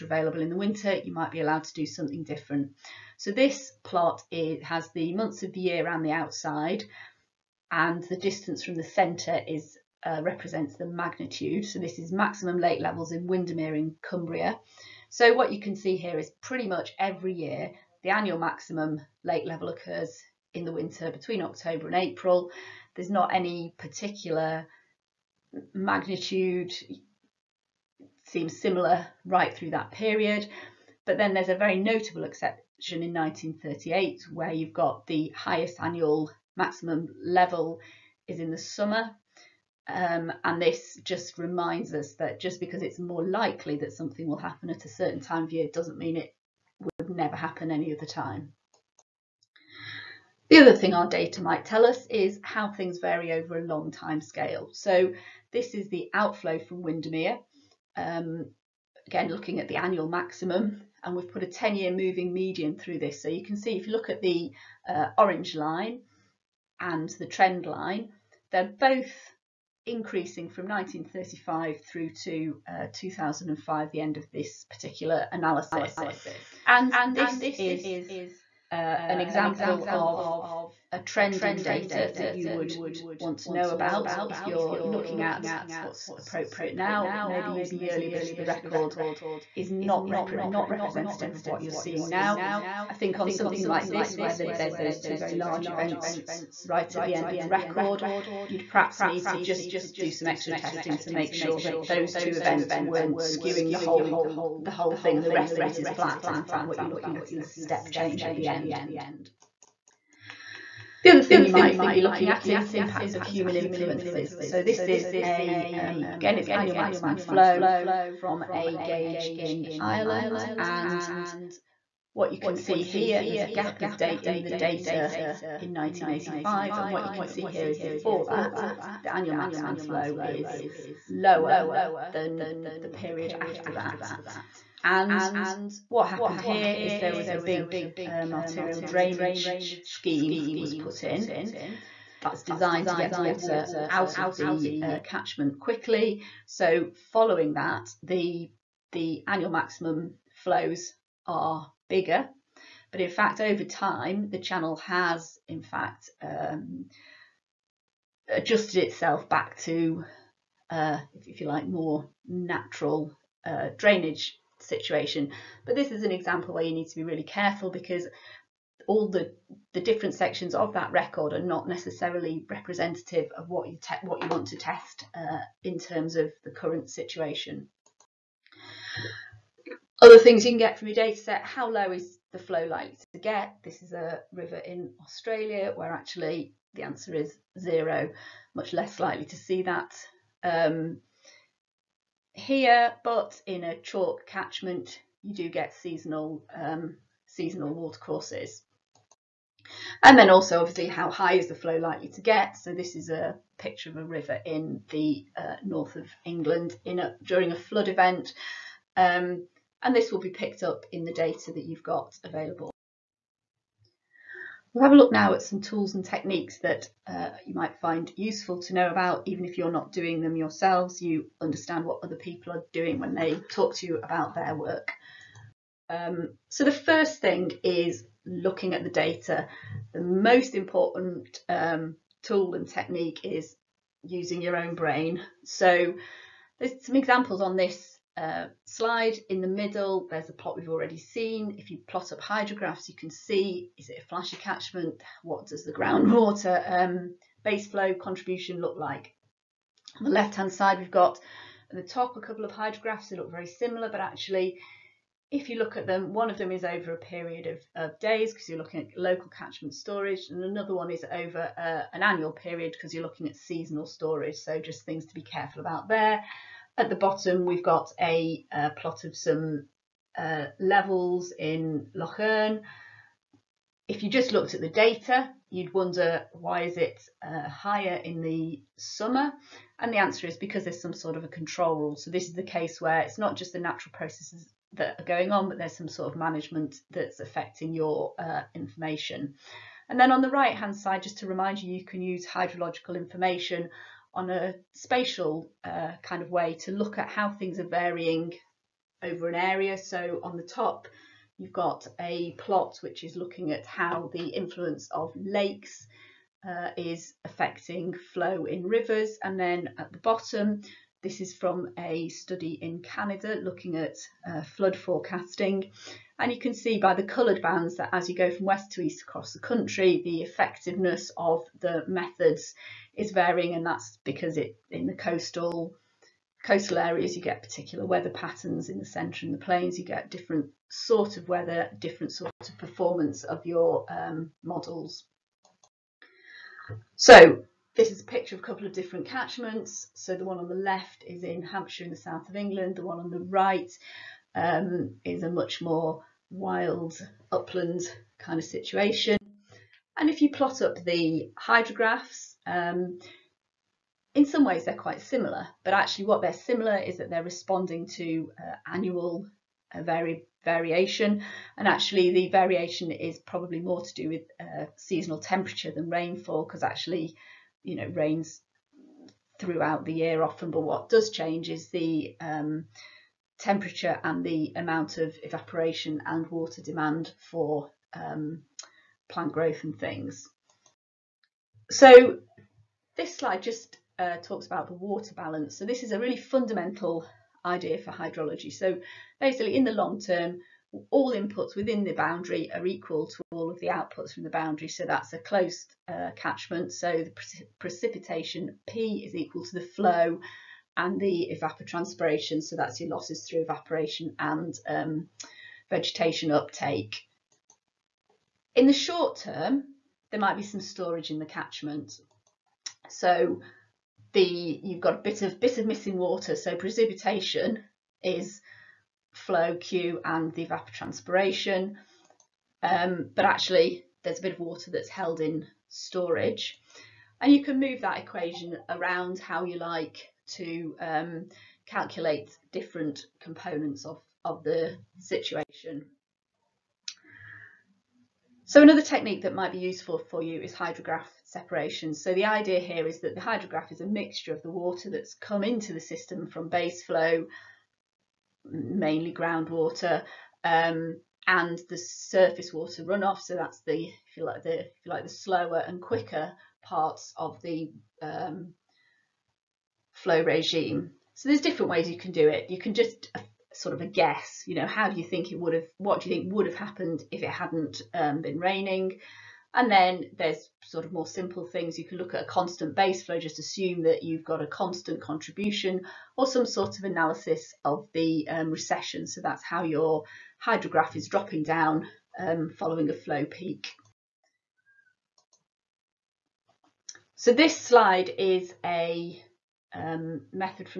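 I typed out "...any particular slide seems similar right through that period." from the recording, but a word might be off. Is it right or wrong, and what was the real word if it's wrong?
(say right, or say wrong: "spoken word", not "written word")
wrong: "magnitude", not "slide".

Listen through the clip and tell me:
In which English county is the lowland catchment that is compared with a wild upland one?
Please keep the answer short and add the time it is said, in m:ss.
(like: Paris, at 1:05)
Hampshire, at 5:41.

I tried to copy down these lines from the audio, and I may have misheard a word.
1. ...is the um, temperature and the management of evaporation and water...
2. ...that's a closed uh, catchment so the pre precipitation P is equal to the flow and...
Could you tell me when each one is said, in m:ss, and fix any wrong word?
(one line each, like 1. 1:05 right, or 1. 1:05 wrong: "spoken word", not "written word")
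1. 6:11 wrong: "amount", not "management"
2. 6:34 right.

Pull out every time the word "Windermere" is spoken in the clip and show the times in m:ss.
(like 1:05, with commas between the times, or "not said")
0:13, 0:56.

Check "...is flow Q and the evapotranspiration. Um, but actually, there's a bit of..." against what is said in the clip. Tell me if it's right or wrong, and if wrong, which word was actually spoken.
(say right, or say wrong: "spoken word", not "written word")
right.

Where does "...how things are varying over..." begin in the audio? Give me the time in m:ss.
4:57.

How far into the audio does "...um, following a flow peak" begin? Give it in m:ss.
8:02.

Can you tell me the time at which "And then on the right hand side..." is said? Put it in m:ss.
4:49.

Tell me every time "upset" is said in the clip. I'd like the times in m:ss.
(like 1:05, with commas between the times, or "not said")
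not said.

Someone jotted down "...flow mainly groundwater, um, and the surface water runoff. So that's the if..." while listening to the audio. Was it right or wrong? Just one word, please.
right.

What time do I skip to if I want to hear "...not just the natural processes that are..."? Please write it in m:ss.
4:43.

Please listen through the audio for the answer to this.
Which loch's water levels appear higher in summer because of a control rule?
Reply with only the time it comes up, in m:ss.
4:31.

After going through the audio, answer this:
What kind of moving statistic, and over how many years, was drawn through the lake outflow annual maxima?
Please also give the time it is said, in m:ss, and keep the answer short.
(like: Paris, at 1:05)
10-year moving median, at 1:01.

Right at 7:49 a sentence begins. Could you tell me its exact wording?
And then there's sort of more simple things.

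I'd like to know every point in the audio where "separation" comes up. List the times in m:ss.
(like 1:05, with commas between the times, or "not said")
7:21.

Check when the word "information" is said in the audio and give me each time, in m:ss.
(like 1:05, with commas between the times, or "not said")
4:48, 4:52.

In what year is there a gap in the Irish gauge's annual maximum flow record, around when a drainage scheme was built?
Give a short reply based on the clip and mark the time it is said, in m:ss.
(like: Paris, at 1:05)
1985, at 2:05.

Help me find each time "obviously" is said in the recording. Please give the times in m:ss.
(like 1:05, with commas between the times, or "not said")
3:20.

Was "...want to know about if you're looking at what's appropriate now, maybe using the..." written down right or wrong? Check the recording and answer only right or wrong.
right.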